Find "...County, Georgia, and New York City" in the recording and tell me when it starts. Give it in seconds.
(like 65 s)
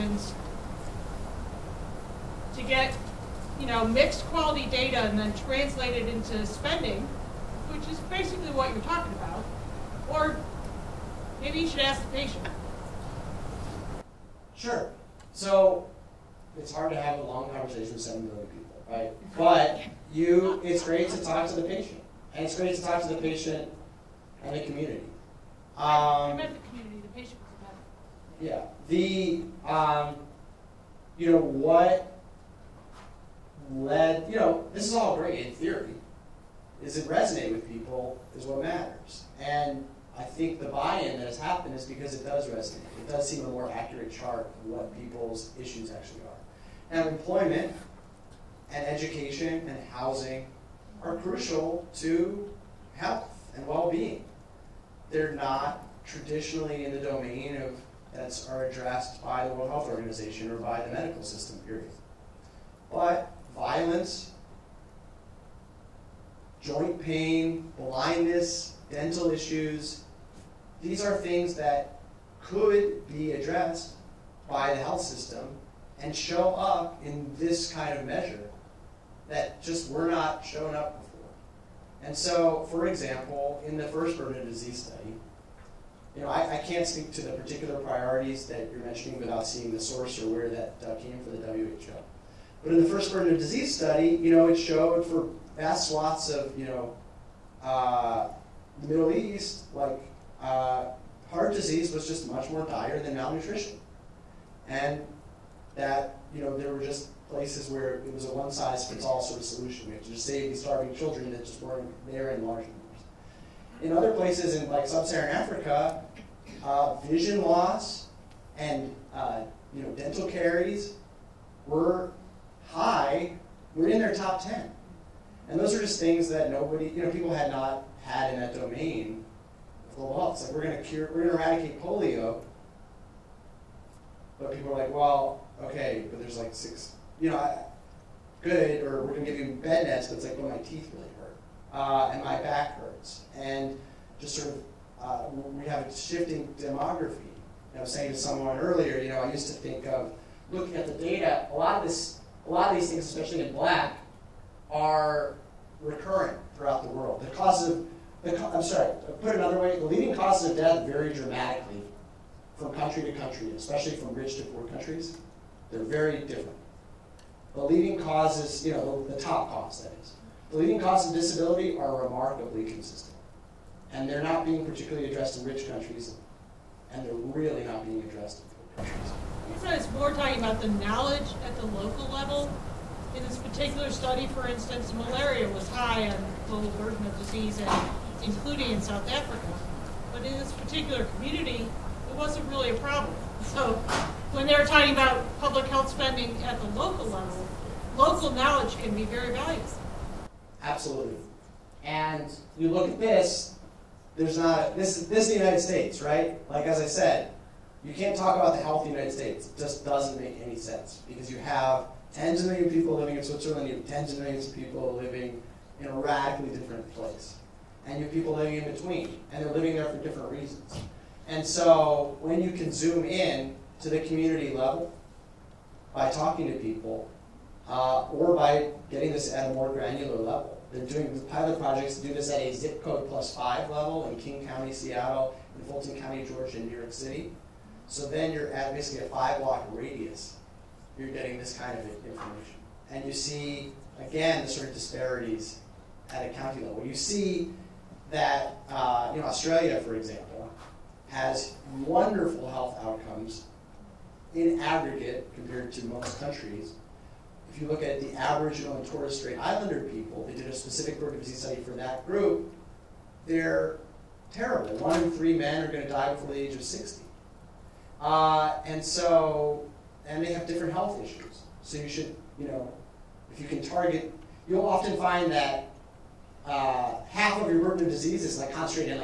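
235 s.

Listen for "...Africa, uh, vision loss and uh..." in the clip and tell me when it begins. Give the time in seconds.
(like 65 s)
115 s.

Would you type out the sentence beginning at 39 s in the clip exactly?
And I think the buy-in that has happened is because it does resonate.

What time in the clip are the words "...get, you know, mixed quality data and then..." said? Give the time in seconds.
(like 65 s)
2 s.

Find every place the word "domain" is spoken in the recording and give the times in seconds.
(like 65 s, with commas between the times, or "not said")
56 s, 128 s.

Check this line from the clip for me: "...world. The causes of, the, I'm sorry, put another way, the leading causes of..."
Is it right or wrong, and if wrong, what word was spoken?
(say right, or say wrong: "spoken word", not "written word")
right.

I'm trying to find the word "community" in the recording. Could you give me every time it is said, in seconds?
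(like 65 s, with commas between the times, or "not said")
24 s, 191 s, 223 s.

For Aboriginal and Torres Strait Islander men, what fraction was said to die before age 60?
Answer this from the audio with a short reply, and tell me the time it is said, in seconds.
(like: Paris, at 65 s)
1 in 3, at 264 s.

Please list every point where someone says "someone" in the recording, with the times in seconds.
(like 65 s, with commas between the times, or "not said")
148 s.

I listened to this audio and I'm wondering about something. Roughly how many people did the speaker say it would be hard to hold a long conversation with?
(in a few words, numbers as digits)
7 million.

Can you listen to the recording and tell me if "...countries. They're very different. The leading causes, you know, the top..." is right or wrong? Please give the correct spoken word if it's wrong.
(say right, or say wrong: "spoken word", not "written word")
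right.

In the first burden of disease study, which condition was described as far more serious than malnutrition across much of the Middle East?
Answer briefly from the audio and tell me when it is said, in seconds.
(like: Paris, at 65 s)
Heart disease, at 101 s.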